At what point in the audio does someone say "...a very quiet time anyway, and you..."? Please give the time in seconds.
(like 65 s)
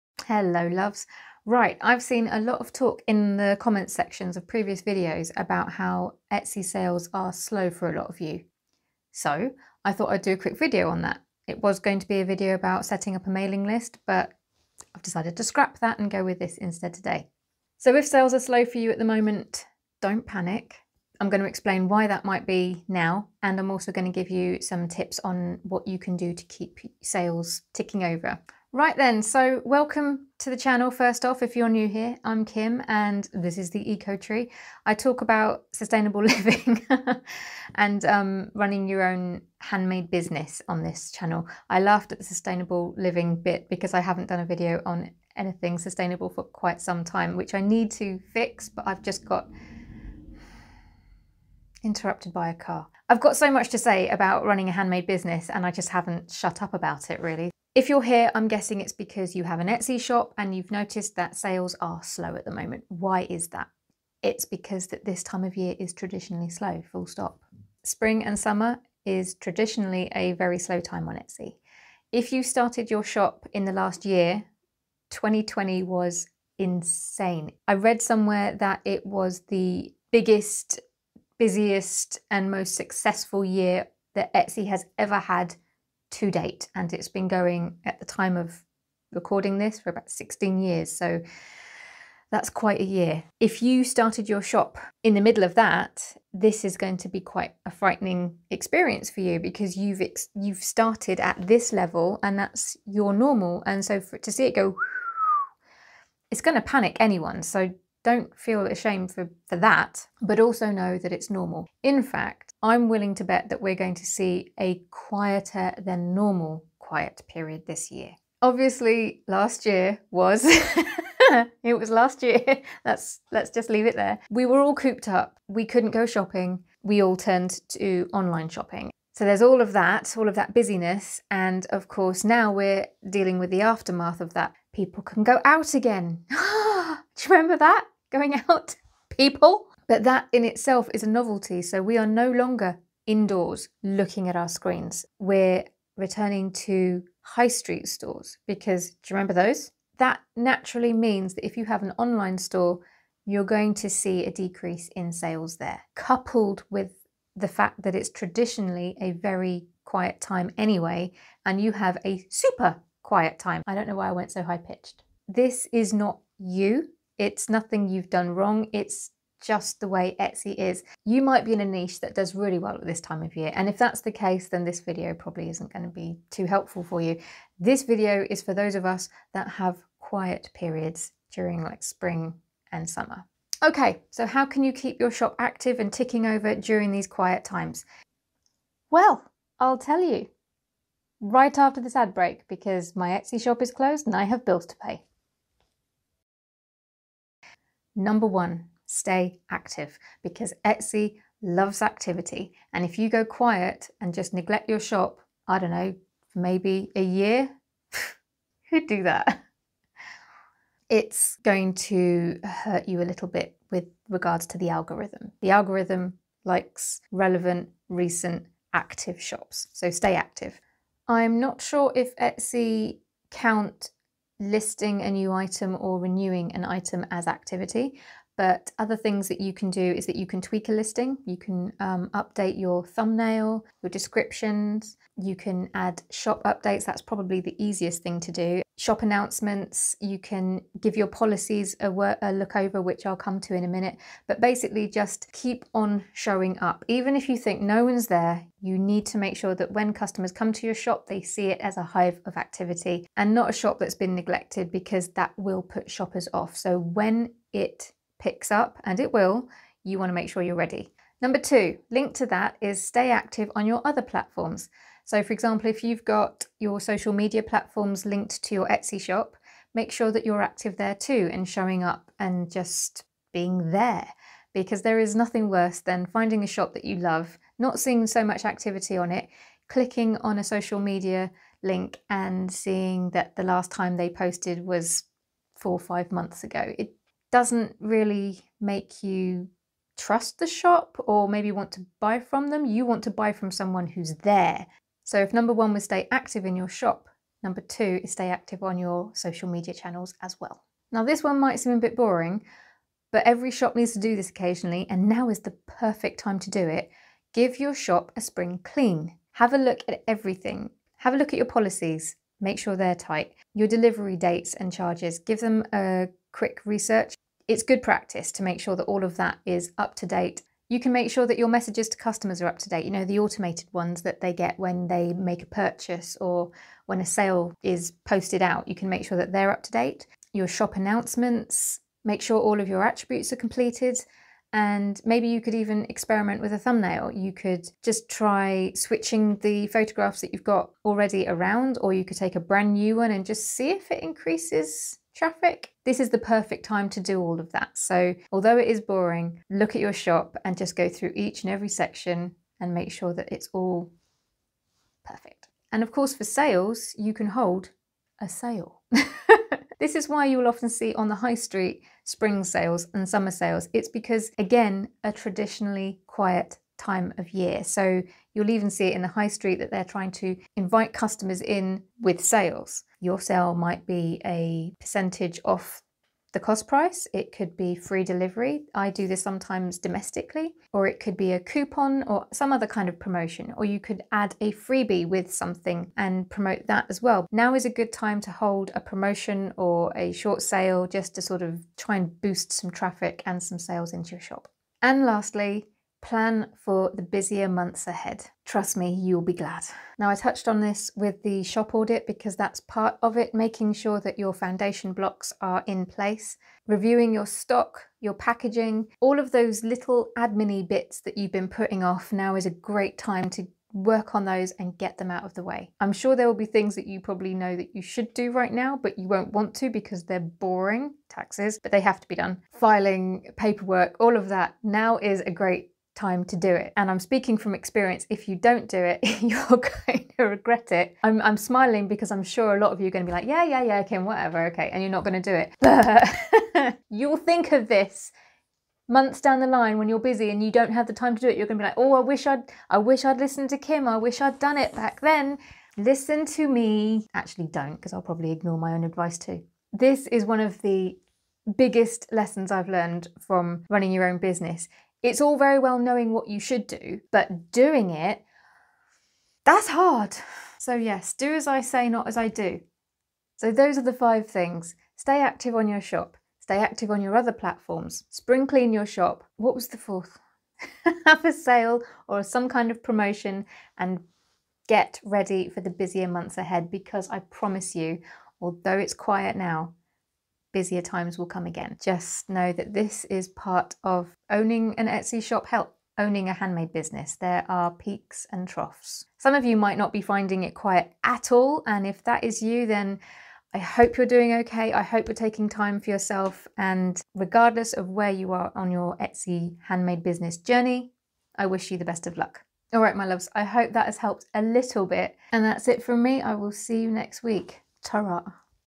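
158 s.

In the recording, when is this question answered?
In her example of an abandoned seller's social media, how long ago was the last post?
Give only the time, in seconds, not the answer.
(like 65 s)
285 s.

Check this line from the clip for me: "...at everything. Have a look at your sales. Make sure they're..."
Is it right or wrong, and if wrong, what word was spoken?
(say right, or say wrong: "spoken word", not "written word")
wrong: "policies", not "sales".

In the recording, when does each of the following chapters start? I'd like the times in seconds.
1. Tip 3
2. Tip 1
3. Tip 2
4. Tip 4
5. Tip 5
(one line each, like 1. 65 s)
1. 306 s
2. 197 s
3. 260 s
4. 355 s
5. 394 s.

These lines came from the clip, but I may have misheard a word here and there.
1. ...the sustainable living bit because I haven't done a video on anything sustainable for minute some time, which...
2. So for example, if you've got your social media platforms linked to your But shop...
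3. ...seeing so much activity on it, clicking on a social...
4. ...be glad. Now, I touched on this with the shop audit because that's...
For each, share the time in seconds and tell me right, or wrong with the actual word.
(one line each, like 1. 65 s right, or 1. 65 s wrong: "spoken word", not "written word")
1. 42 s wrong: "quite", not "minute"
2. 265 s wrong: "Etsy", not "But"
3. 277 s right
4. 399 s right.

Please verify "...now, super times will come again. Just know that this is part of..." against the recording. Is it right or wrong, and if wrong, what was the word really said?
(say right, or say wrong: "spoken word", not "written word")
wrong: "busier", not "super".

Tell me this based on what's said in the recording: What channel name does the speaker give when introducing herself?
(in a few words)
The Beech Tree.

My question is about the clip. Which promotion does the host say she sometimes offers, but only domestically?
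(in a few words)
Free delivery.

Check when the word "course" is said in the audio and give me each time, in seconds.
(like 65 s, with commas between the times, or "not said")
131 s, 355 s.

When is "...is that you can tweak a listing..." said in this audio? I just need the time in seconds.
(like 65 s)
229 s.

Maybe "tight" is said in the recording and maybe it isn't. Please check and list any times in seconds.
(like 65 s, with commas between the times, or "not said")
312 s.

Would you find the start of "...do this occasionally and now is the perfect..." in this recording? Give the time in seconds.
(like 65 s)
303 s.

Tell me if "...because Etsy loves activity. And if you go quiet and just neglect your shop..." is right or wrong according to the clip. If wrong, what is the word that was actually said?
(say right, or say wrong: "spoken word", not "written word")
right.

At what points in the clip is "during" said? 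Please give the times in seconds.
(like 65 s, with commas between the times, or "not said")
181 s, 186 s.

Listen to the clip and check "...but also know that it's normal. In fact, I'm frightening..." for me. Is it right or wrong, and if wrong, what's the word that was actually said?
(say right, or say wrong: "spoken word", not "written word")
wrong: "willing", not "frightening".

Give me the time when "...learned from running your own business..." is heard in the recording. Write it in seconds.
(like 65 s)
452 s.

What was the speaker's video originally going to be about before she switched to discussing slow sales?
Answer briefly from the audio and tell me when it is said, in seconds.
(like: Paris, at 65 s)
Setting up a mailing list, at 12 s.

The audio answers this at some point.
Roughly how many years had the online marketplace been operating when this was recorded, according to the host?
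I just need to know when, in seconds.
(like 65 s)
90 s.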